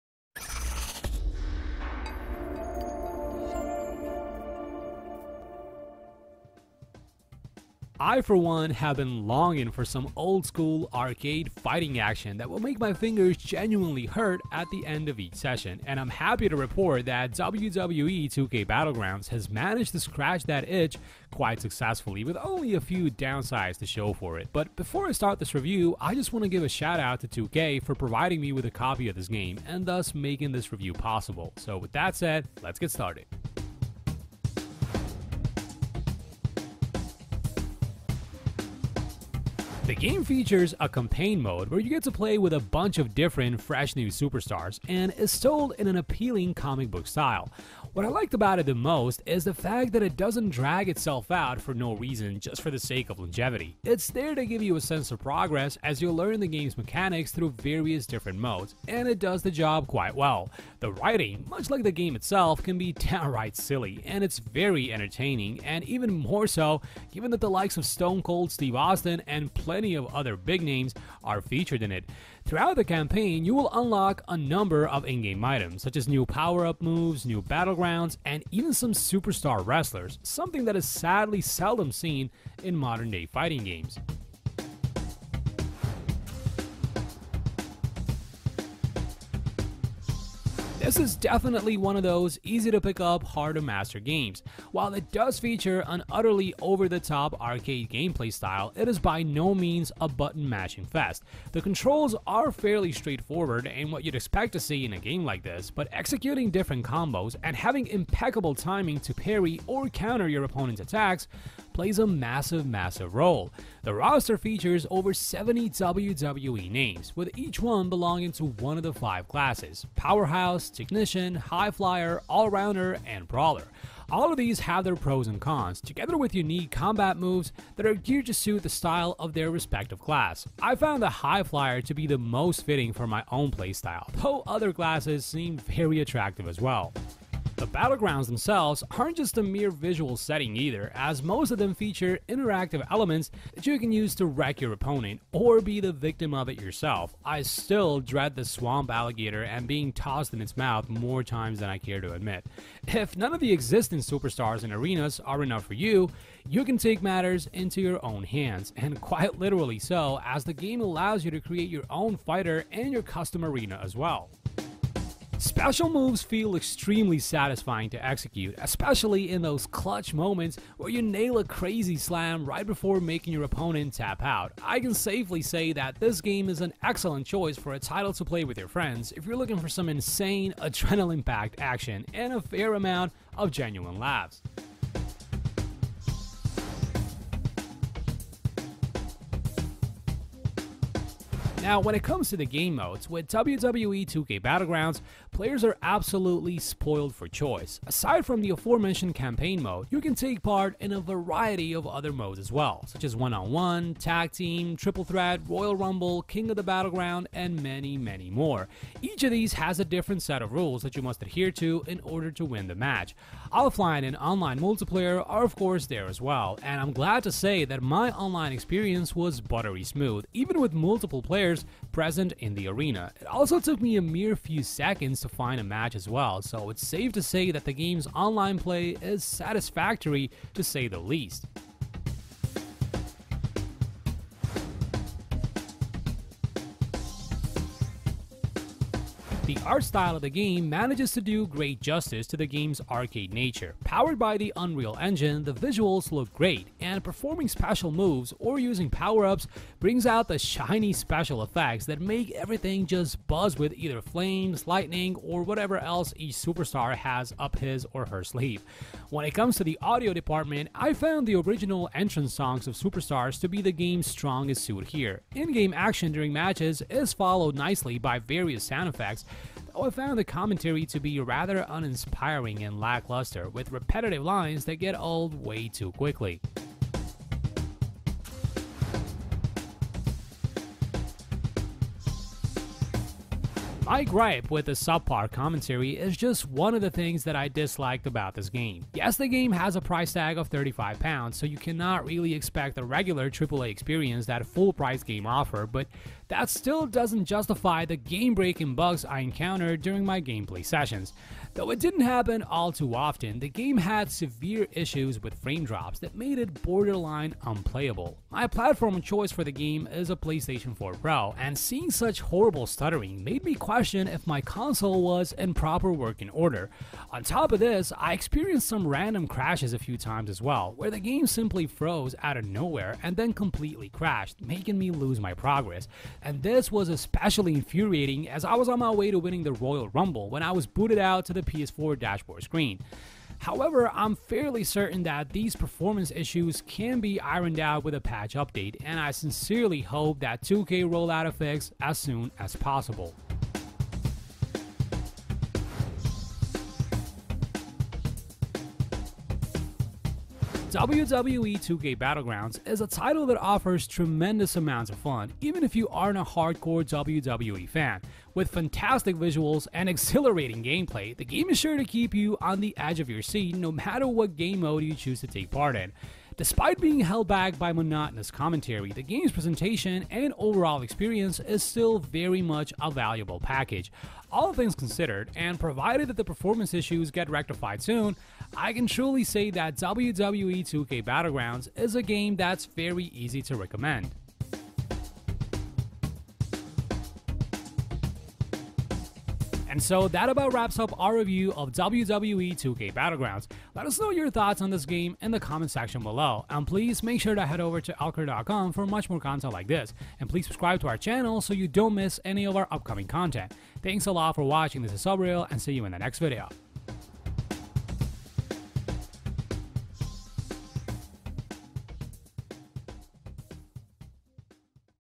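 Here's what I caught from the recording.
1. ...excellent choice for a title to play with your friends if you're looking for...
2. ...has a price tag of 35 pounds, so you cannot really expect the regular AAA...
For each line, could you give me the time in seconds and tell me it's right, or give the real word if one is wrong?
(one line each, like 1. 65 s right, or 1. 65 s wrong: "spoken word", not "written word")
1. 176 s right
2. 289 s right.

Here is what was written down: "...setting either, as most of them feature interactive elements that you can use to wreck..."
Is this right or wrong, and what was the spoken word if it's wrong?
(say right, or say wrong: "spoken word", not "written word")
right.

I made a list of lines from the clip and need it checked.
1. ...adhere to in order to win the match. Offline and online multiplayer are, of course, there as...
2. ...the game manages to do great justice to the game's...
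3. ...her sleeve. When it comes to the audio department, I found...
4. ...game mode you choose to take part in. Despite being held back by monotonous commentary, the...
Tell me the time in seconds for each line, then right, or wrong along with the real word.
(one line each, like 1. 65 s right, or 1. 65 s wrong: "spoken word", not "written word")
1. 211 s right
2. 240 s right
3. 258 s right
4. 364 s right.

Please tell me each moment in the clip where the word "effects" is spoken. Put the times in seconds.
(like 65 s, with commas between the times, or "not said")
251 s, 268 s.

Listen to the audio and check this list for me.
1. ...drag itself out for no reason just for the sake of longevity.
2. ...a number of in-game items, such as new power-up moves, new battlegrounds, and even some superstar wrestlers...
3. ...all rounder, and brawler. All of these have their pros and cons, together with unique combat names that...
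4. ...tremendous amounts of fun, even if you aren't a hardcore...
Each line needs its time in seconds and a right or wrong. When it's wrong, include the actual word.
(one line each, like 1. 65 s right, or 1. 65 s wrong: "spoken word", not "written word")
1. 50 s right
2. 74 s right
3. 122 s wrong: "moves", not "names"
4. 353 s right.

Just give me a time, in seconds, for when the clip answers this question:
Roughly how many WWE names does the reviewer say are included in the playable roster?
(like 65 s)
114 s.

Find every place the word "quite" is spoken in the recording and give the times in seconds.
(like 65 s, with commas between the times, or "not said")
21 s, 59 s, 158 s.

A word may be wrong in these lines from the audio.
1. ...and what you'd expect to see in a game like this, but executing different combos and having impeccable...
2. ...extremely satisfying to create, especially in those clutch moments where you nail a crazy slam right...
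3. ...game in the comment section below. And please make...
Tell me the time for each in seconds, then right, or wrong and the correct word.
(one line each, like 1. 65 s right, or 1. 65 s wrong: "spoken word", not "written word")
1. 103 s right
2. 166 s wrong: "execute", not "create"
3. 394 s right.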